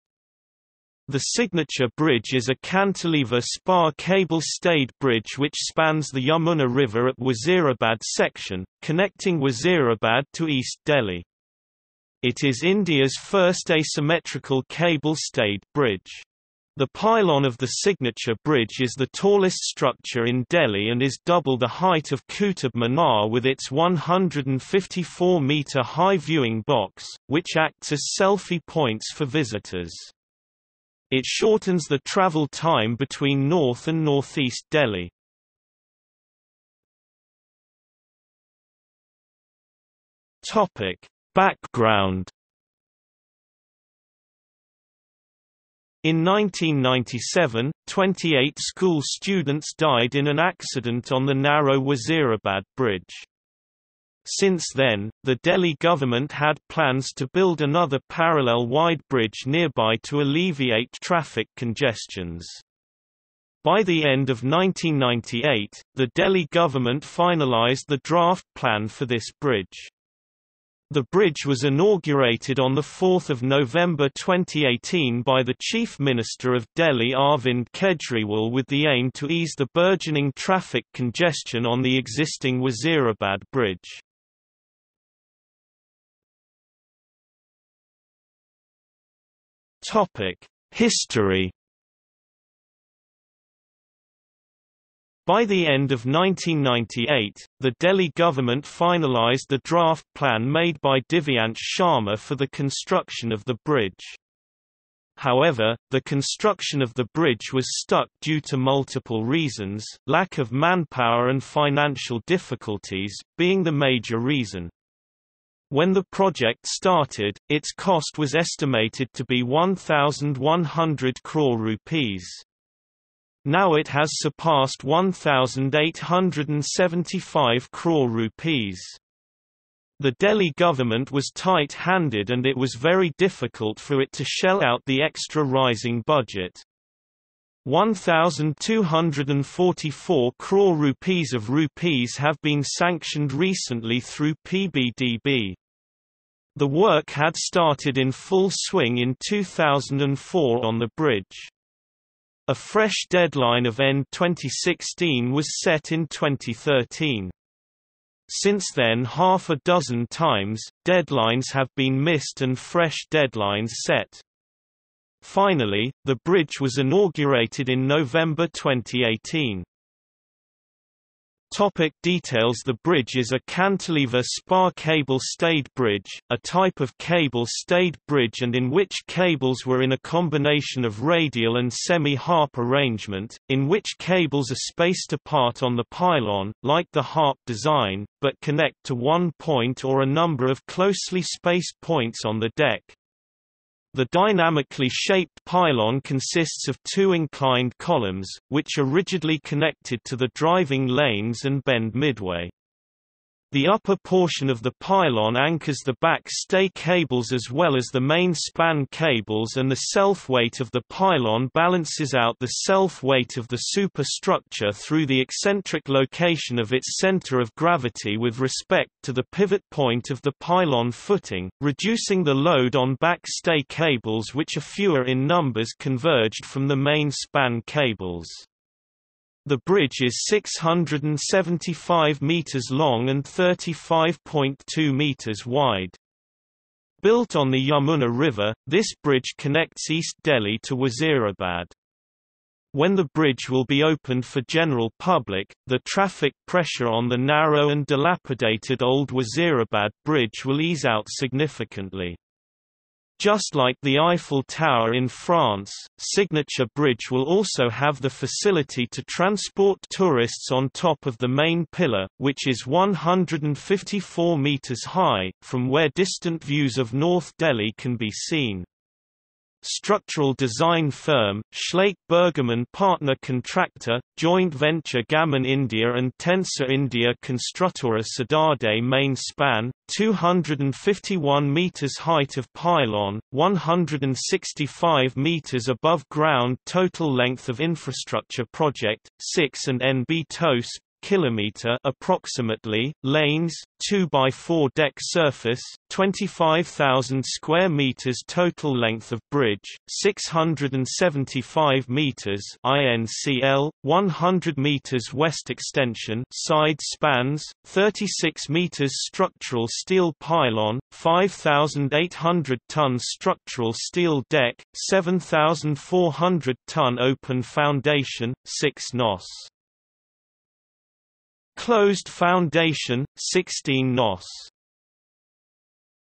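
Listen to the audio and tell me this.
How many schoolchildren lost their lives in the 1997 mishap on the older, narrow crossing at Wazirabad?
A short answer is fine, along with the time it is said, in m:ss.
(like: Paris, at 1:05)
28, at 0:47.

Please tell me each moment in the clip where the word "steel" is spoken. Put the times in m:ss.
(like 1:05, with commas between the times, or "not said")
5:09, 5:13.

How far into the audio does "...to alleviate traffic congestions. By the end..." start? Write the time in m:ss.
1:00.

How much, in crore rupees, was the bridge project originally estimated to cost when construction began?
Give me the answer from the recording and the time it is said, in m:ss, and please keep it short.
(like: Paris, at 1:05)
1,100 crore rupees, at 1:59.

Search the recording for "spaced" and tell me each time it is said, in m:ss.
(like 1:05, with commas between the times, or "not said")
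3:04, 3:11.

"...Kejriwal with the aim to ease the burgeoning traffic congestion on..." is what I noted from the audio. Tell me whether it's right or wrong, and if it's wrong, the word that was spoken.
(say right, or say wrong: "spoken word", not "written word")
right.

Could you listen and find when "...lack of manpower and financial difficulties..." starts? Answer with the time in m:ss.
1:50.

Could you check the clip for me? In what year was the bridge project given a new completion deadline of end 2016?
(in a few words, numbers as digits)
2013.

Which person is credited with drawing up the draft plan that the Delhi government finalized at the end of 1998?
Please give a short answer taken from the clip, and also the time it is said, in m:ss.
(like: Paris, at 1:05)
Divyansh Sharma, at 1:41.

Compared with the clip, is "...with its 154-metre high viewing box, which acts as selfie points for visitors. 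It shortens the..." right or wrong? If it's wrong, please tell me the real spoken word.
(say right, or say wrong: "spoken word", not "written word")
right.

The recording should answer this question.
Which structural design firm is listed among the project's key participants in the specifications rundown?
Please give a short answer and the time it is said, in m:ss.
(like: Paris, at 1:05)
Schlaich Bergermann partner, at 4:31.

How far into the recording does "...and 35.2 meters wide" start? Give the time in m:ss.
3:53.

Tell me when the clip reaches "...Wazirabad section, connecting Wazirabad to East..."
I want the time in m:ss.
0:07.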